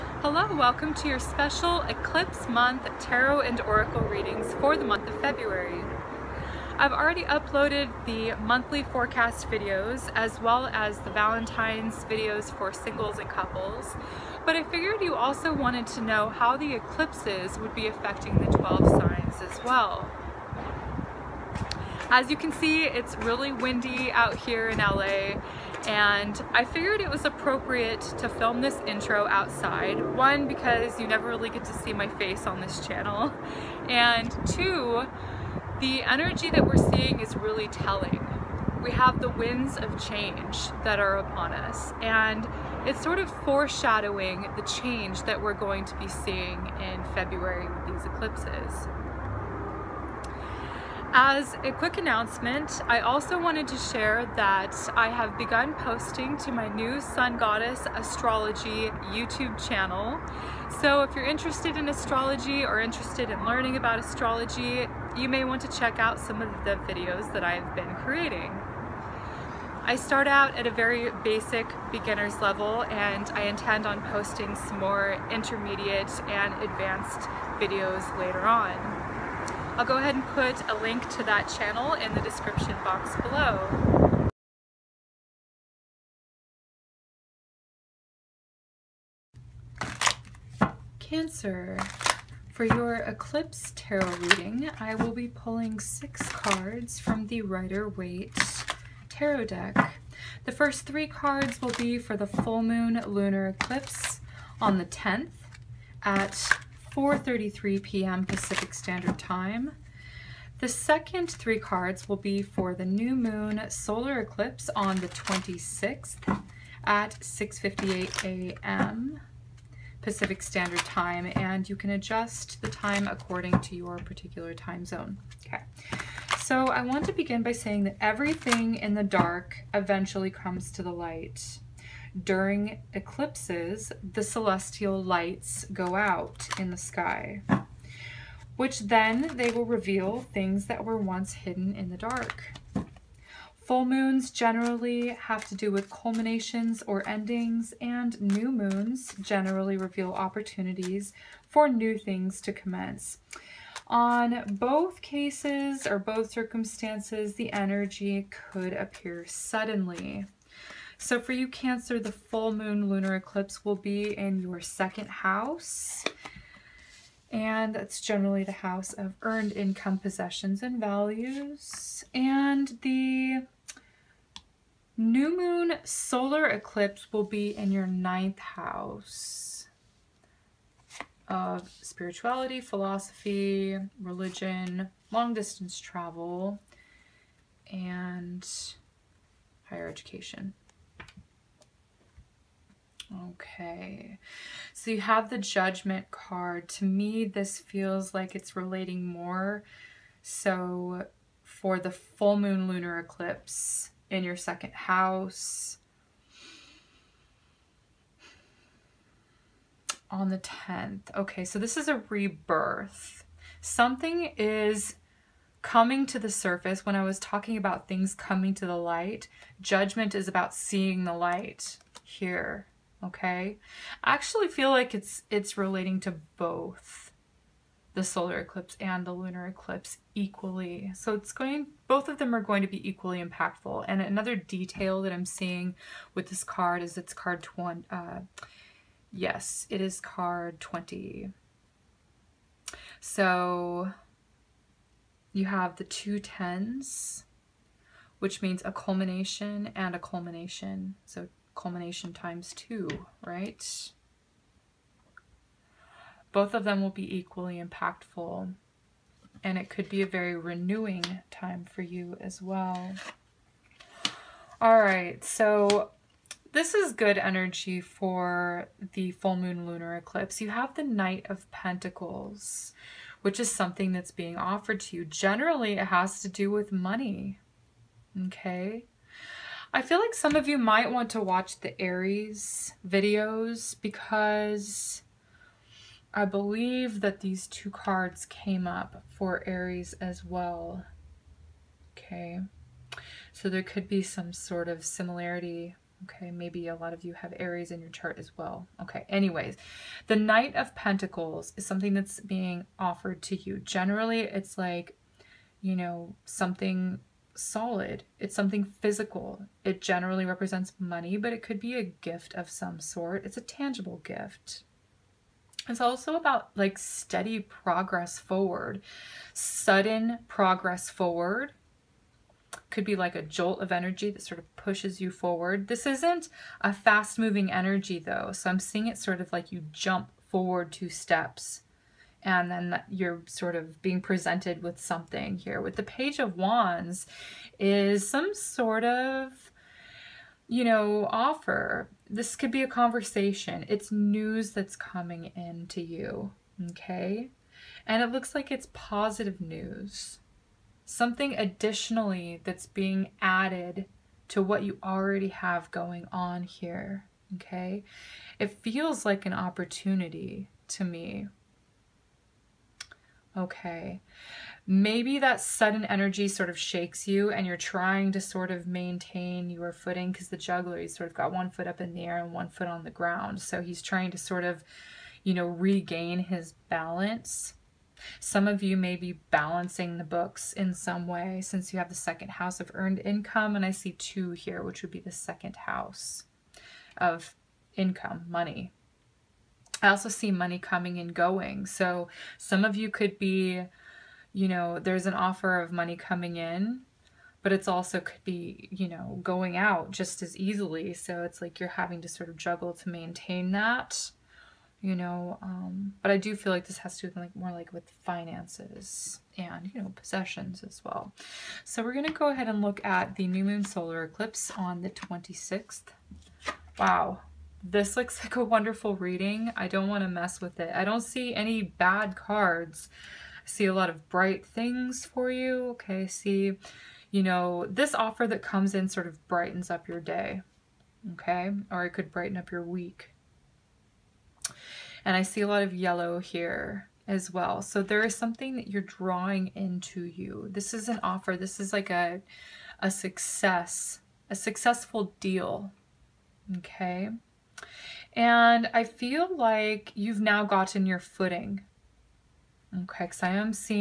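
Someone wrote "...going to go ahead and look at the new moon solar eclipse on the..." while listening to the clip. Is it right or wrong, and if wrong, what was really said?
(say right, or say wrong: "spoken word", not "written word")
right.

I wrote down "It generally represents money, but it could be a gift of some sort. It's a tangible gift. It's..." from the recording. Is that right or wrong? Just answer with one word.
right.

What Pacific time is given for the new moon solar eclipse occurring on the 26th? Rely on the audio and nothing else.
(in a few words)
6:58 a.m.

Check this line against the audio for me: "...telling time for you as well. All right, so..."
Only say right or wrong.
wrong.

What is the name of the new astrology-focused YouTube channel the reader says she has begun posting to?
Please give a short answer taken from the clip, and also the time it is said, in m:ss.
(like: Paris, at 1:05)
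Sun Goddess Astrology, at 0:56.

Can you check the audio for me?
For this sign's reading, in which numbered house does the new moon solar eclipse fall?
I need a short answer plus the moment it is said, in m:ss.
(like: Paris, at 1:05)
ninth, at 2:57.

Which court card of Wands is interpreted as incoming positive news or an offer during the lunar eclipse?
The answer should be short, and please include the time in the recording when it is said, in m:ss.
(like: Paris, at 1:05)
Page of Wands, at 5:35.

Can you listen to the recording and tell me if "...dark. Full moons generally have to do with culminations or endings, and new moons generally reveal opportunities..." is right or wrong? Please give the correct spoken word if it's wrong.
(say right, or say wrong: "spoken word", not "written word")
right.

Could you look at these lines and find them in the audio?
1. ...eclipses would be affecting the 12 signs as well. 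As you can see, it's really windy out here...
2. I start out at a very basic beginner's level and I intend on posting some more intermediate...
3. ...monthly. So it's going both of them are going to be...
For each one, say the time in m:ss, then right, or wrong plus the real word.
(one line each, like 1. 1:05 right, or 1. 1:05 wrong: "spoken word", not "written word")
1. 0:16 right
2. 1:09 right
3. 3:50 wrong: "equally", not "monthly".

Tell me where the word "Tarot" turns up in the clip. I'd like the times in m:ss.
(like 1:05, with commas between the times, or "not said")
0:02, 1:33, 1:39.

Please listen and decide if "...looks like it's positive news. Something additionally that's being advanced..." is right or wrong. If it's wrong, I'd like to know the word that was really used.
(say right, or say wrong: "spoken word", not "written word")
wrong: "added", not "advanced".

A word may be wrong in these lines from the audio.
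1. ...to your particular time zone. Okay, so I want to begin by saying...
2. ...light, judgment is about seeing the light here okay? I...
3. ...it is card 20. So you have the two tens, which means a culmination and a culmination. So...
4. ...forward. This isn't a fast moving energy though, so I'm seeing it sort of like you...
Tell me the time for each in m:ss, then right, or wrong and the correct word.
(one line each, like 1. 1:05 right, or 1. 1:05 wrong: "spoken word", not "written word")
1. 2:03 right
2. 3:38 right
3. 3:59 right
4. 5:25 right.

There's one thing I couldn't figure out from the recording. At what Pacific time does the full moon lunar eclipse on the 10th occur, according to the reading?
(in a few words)
4:33 p.m.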